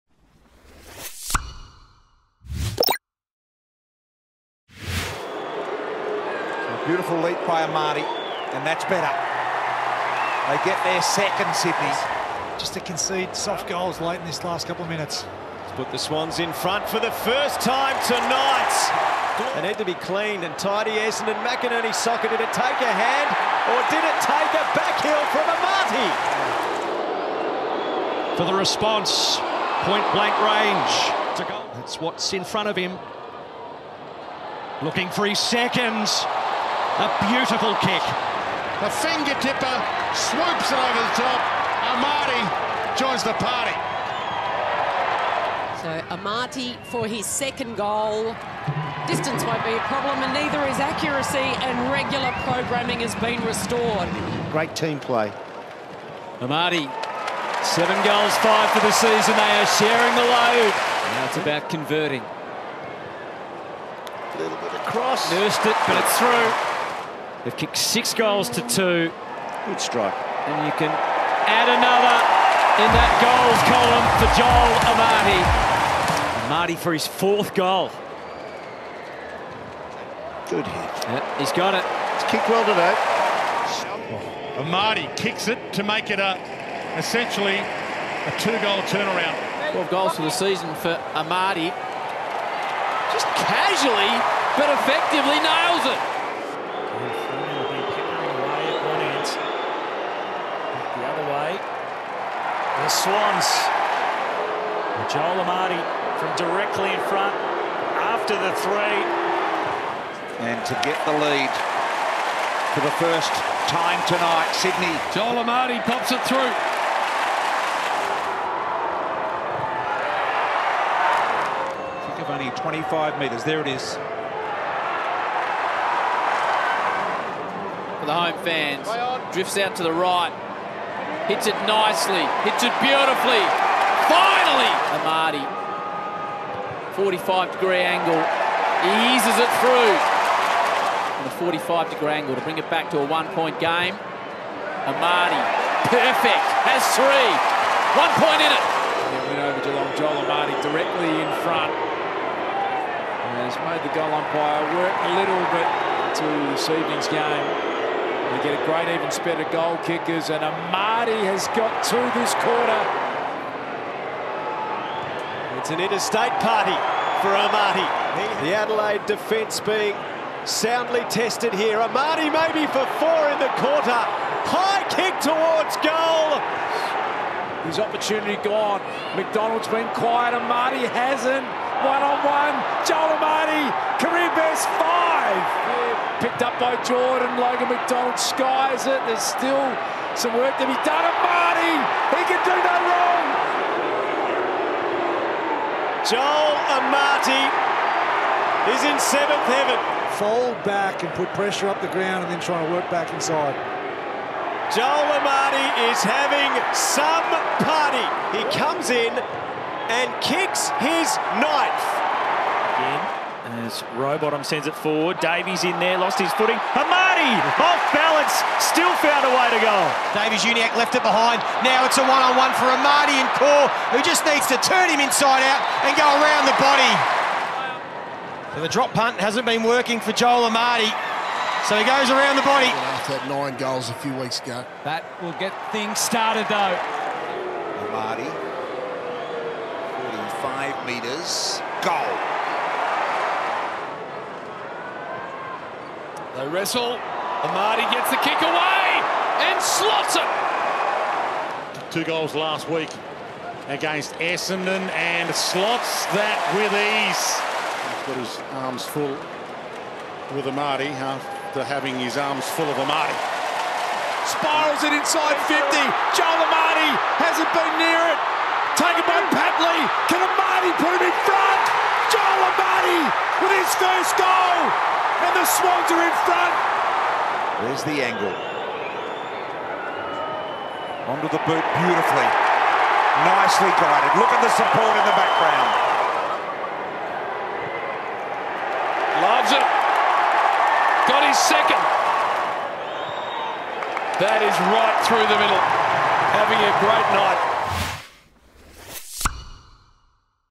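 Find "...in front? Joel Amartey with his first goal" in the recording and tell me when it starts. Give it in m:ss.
4:31.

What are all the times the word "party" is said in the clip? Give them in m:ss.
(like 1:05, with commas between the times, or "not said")
0:43, 2:46, 3:27.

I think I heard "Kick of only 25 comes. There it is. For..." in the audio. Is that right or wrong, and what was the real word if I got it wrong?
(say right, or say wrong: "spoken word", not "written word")
wrong: "metres", not "comes".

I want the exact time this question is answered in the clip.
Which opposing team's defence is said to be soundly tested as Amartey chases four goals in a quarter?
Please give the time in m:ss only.
2:48.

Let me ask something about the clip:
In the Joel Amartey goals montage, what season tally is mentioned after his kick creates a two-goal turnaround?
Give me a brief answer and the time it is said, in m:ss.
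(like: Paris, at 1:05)
12, at 1:29.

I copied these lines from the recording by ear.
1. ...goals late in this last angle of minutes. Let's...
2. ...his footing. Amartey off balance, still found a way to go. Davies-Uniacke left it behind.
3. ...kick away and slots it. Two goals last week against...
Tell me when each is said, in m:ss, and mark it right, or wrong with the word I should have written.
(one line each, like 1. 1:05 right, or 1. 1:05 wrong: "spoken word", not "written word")
1. 0:13 wrong: "couple", not "angle"
2. 3:36 right
3. 4:08 right.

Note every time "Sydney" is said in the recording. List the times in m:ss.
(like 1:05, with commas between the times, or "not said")
0:11, 1:54.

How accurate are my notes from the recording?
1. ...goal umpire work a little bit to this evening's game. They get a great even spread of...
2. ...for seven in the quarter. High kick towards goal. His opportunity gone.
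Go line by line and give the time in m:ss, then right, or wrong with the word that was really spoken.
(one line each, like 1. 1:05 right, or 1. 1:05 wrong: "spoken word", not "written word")
1. 2:33 right
2. 2:52 wrong: "four", not "seven".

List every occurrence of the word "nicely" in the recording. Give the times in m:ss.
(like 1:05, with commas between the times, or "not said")
2:11, 4:43.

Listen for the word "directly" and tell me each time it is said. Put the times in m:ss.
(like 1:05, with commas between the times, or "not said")
1:46, 2:30.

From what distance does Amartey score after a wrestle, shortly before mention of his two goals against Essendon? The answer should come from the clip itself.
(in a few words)
5 metres.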